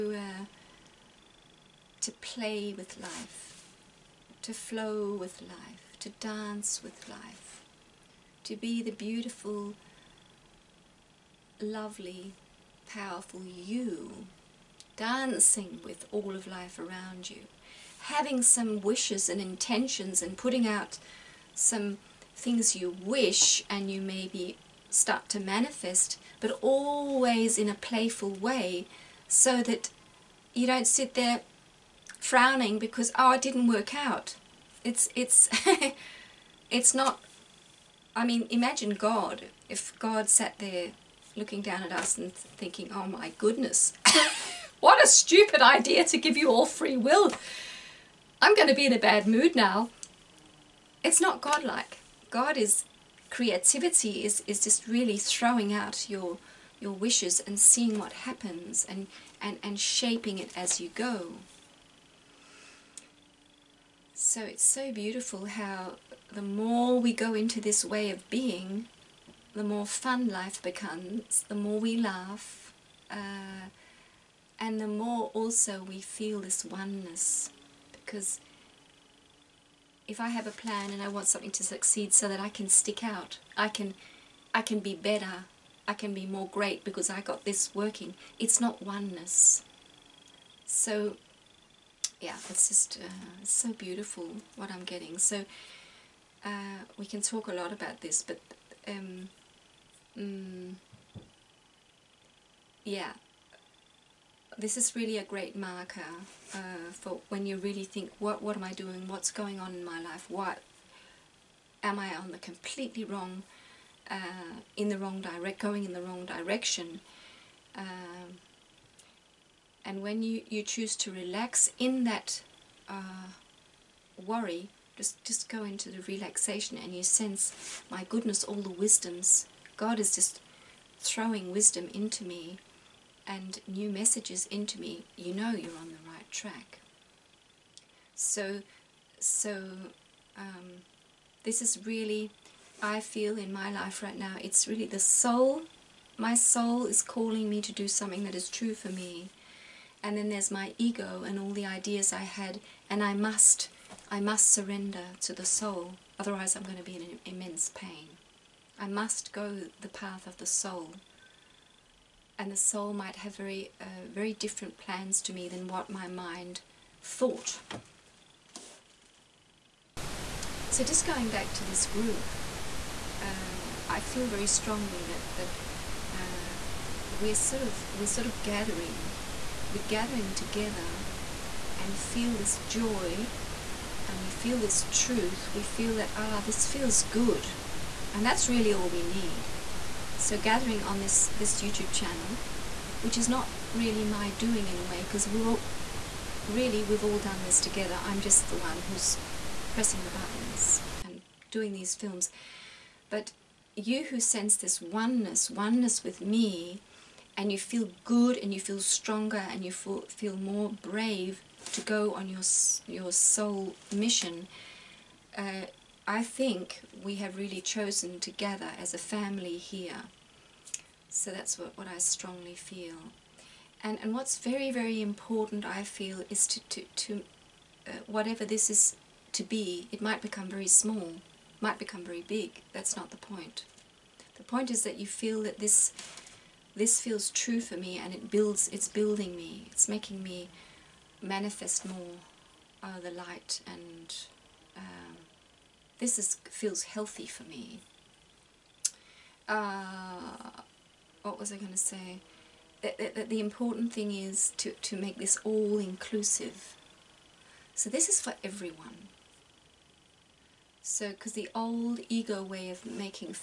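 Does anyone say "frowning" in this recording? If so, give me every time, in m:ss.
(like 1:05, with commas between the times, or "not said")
0:32.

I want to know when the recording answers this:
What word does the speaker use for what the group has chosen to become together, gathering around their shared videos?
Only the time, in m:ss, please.
3:38.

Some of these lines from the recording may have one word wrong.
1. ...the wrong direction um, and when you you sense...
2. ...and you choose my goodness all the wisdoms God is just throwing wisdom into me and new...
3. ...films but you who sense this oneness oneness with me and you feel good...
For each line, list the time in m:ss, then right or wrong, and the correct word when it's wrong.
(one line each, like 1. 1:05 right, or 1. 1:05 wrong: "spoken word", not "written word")
1. 1:55 wrong: "choose", not "sense"
2. 2:06 wrong: "sense", not "choose"
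3. 3:21 right.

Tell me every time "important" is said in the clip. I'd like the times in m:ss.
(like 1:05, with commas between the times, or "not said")
3:45, 4:13.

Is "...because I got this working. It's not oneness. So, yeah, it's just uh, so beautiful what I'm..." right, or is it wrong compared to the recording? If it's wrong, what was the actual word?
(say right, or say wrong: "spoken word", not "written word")
right.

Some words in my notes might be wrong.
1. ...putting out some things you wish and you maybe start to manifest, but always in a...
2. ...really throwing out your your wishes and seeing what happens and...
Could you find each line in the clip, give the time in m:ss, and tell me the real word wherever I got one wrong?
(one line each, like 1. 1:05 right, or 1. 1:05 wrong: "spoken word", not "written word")
1. 0:20 right
2. 0:54 right.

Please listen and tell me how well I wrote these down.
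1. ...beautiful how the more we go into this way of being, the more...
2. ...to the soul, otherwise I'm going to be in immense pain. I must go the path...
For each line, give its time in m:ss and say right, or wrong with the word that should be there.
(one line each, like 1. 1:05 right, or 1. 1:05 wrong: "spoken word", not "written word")
1. 1:04 right
2. 2:35 right.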